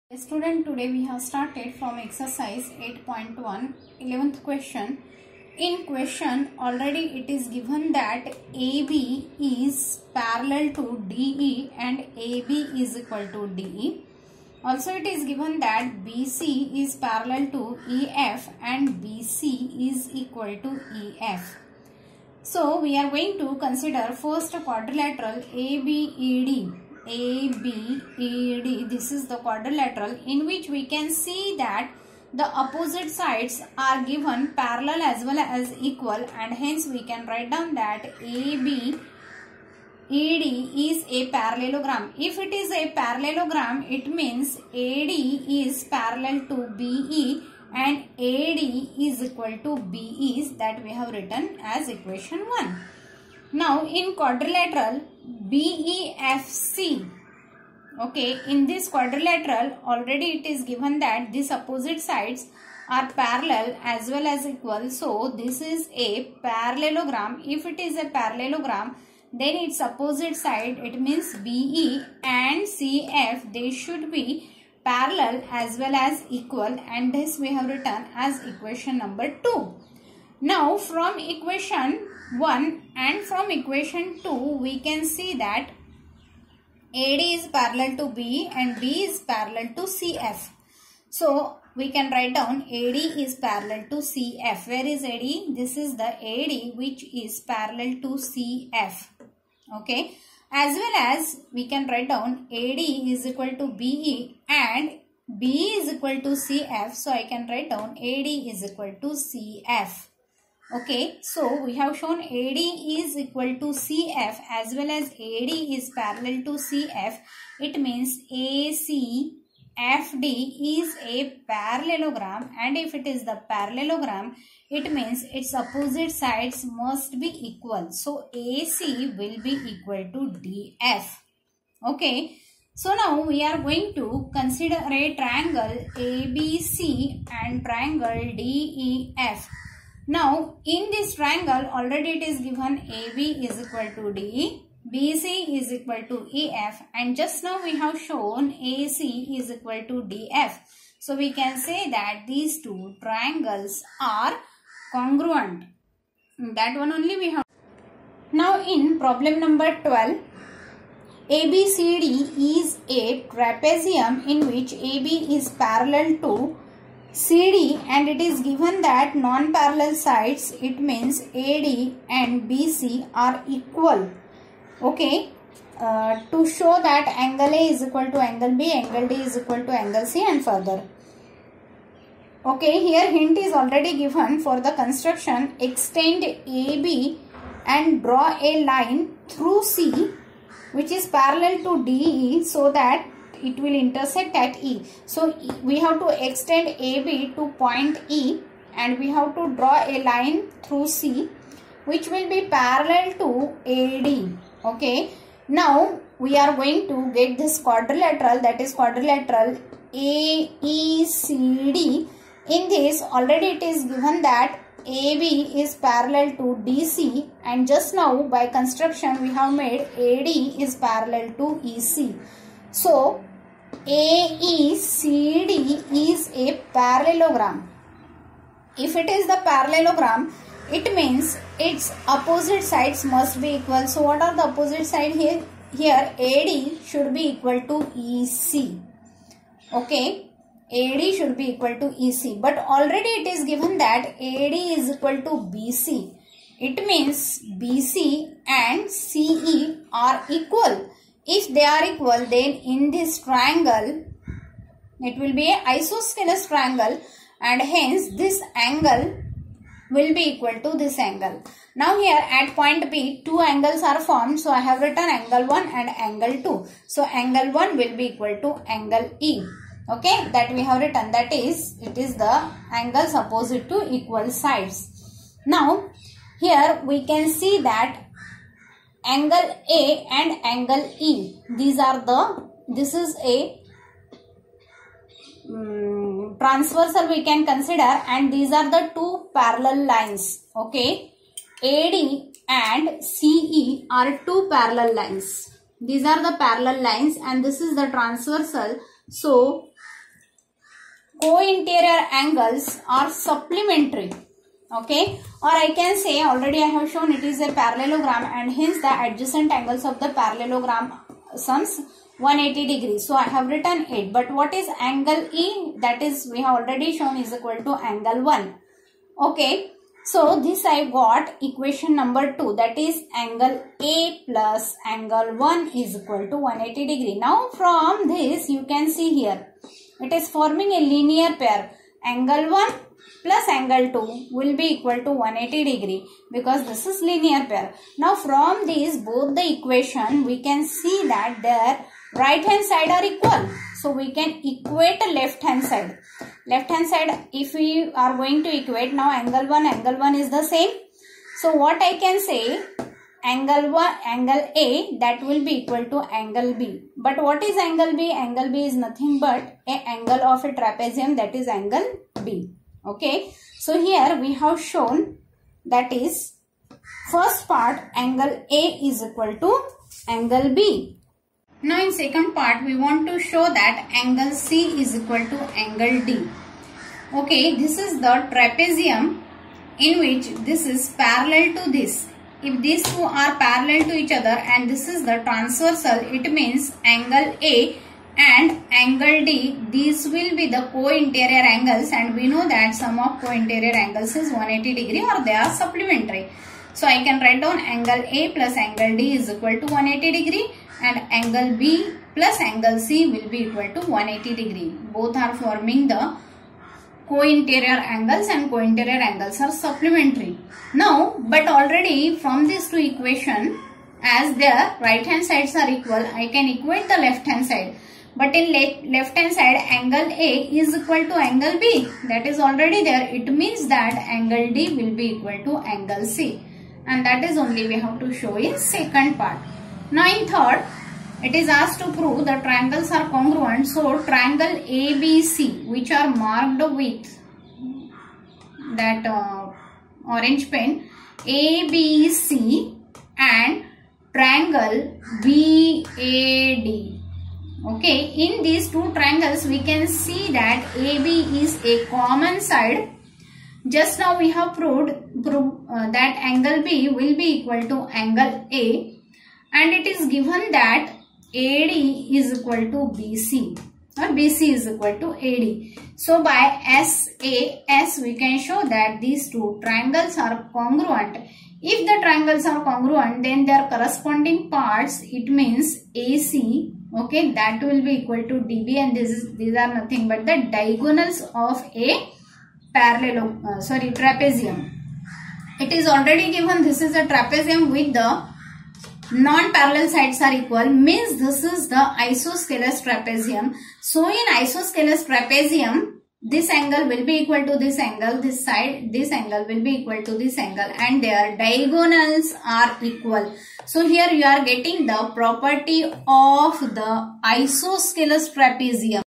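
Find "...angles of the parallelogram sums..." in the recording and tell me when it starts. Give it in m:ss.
5:09.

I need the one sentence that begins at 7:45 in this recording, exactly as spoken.
So by SAS we can show that these two triangles are congruent.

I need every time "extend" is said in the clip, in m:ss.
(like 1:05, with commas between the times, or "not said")
3:05, 3:16.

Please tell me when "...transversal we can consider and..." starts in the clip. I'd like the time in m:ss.
4:46.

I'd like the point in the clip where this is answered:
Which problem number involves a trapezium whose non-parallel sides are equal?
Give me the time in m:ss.
2:38.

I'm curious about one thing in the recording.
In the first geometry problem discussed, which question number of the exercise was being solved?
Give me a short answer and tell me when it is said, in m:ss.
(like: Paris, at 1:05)
11, at 0:04.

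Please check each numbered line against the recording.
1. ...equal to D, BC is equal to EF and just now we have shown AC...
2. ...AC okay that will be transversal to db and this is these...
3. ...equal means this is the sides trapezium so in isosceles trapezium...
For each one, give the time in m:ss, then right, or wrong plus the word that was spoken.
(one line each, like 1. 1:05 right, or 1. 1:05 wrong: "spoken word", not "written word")
1. 2:23 right
2. 7:55 wrong: "equal", not "transversal"
3. 8:10 wrong: "isosceles", not "sides".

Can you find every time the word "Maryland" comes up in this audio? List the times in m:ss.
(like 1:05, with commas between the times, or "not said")
not said.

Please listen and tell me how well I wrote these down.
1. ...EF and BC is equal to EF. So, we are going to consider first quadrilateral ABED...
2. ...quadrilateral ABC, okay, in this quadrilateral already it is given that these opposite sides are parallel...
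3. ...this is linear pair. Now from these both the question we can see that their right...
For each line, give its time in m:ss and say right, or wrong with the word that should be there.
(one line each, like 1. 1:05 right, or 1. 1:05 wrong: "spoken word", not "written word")
1. 0:17 right
2. 0:54 wrong: "BEFC", not "ABC"
3. 5:36 wrong: "equation", not "question".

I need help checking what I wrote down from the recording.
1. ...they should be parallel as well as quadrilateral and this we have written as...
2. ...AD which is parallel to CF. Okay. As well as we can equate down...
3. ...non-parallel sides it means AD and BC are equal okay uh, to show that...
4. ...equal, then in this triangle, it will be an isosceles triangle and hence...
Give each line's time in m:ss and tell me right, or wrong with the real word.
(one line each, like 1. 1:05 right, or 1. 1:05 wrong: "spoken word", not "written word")
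1. 1:13 wrong: "equal", not "quadrilateral"
2. 1:36 wrong: "write", not "equate"
3. 2:49 right
4. 4:11 right.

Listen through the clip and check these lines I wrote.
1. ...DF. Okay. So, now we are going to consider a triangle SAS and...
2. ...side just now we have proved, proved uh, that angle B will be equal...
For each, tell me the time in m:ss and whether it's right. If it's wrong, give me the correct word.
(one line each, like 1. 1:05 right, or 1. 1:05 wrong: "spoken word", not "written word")
1. 2:10 wrong: "ABC", not "SAS"
2. 7:32 right.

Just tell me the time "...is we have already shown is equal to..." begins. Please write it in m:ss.
5:16.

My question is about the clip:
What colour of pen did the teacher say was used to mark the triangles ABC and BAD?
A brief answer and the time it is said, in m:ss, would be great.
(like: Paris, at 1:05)
orange, at 7:20.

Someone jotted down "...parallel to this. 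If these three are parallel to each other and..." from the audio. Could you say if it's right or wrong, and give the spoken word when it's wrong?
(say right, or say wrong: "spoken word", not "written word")
wrong: "two", not "three".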